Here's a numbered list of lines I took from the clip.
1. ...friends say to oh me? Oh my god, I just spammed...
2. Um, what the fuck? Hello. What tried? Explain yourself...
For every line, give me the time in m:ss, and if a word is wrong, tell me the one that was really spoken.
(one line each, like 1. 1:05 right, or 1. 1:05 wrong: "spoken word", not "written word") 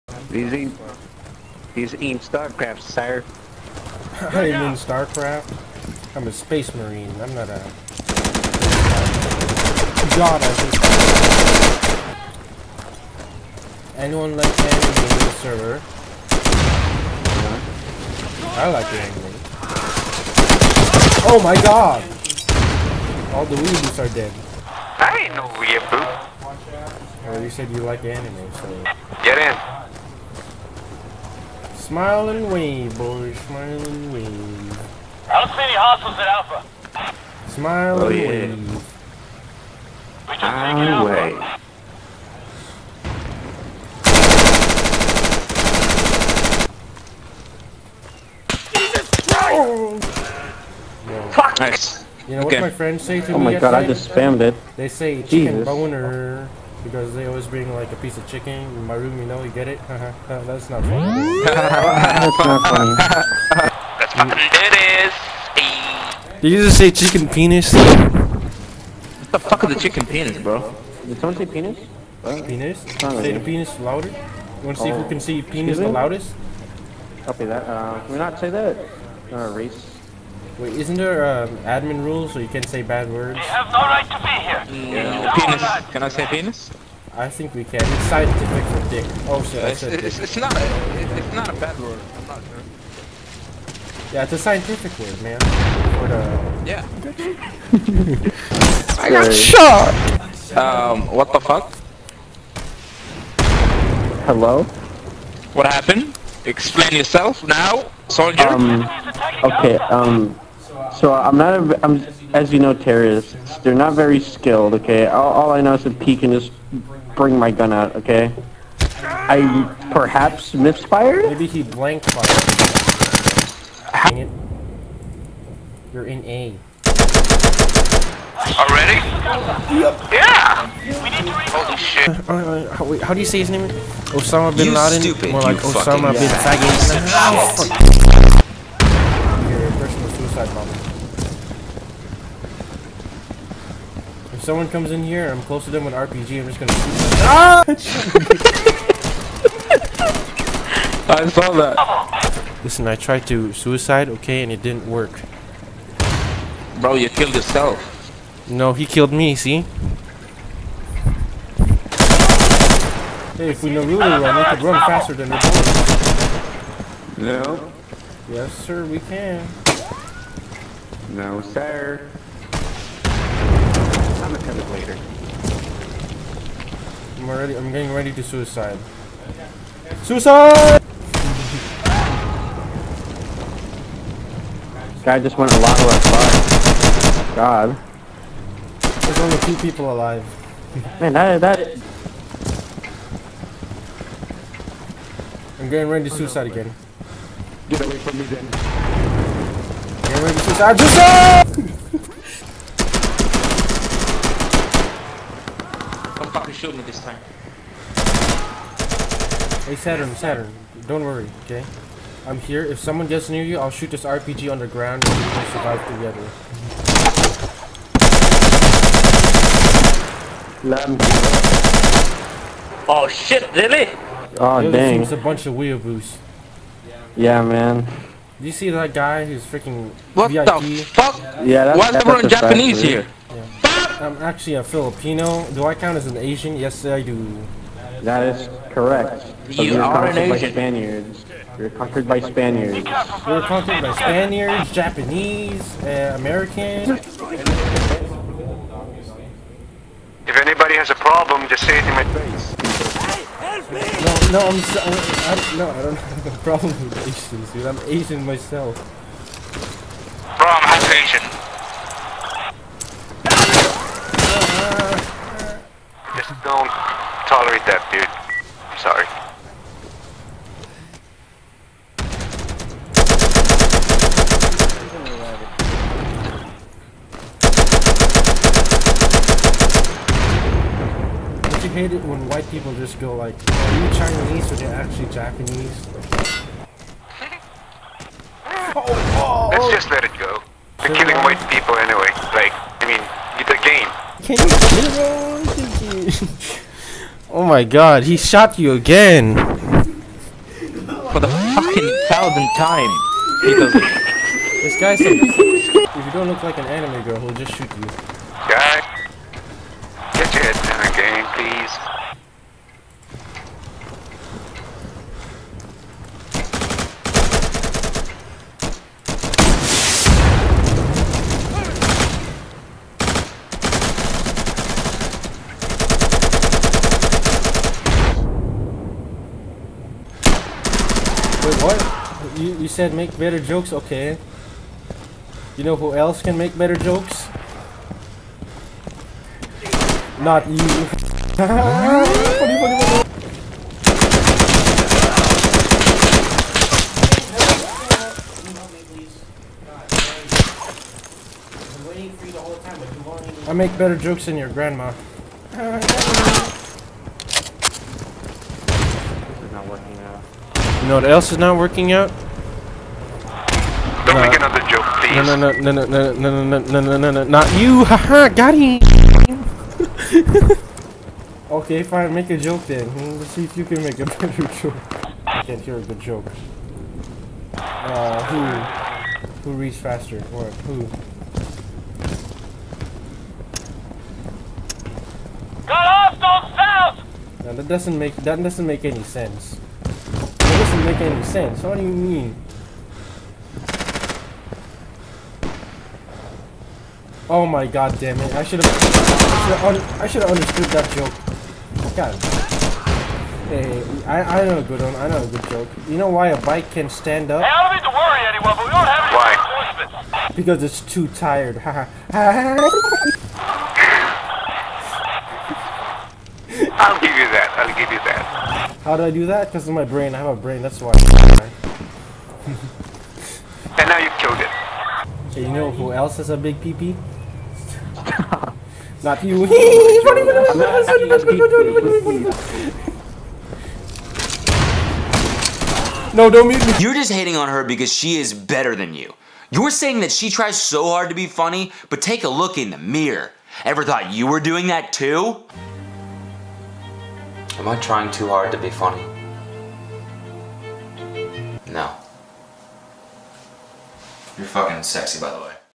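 1. 0:52 right
2. 1:40 wrong: "happened", not "tried".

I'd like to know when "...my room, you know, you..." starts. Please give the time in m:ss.
0:58.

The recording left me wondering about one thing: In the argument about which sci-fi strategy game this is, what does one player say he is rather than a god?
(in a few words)
space marine.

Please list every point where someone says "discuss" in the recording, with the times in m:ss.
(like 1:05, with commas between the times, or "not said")
not said.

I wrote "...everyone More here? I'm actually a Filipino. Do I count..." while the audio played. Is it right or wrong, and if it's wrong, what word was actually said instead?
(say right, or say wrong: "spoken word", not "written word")
wrong: "Japanese", not "More".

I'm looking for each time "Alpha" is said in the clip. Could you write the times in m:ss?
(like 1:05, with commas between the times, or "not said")
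0:36, 0:49.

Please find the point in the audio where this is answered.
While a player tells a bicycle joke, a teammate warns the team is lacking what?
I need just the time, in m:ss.
6:49.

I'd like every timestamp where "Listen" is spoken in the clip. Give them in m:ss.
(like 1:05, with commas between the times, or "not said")
2:32.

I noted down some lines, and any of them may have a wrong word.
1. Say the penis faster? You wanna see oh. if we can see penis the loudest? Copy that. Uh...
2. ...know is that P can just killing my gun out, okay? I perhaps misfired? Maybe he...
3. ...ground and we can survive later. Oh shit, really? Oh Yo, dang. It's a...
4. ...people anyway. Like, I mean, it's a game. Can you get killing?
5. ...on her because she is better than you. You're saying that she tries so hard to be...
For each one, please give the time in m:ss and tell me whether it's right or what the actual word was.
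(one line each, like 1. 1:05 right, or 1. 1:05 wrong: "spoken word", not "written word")
1. 1:12 wrong: "louder", not "faster"
2. 1:55 wrong: "bring", not "killing"
3. 3:34 wrong: "together", not "later"
4. 4:51 wrong: "wrong", not "killing"
5. 7:17 right.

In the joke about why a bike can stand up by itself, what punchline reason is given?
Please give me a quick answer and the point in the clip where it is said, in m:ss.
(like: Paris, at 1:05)
because it's too tired, at 6:50.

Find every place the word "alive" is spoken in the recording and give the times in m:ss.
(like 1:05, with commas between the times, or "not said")
3:09.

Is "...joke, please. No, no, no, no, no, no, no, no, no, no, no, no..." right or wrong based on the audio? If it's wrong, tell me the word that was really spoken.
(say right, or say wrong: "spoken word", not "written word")
right.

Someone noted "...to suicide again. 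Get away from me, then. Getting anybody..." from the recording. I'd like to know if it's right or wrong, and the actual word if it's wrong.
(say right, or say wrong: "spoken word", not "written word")
wrong: "ready", not "anybody".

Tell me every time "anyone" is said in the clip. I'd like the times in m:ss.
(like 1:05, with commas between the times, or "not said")
0:13, 6:48.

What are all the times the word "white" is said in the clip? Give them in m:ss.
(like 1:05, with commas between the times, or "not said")
4:42, 4:51.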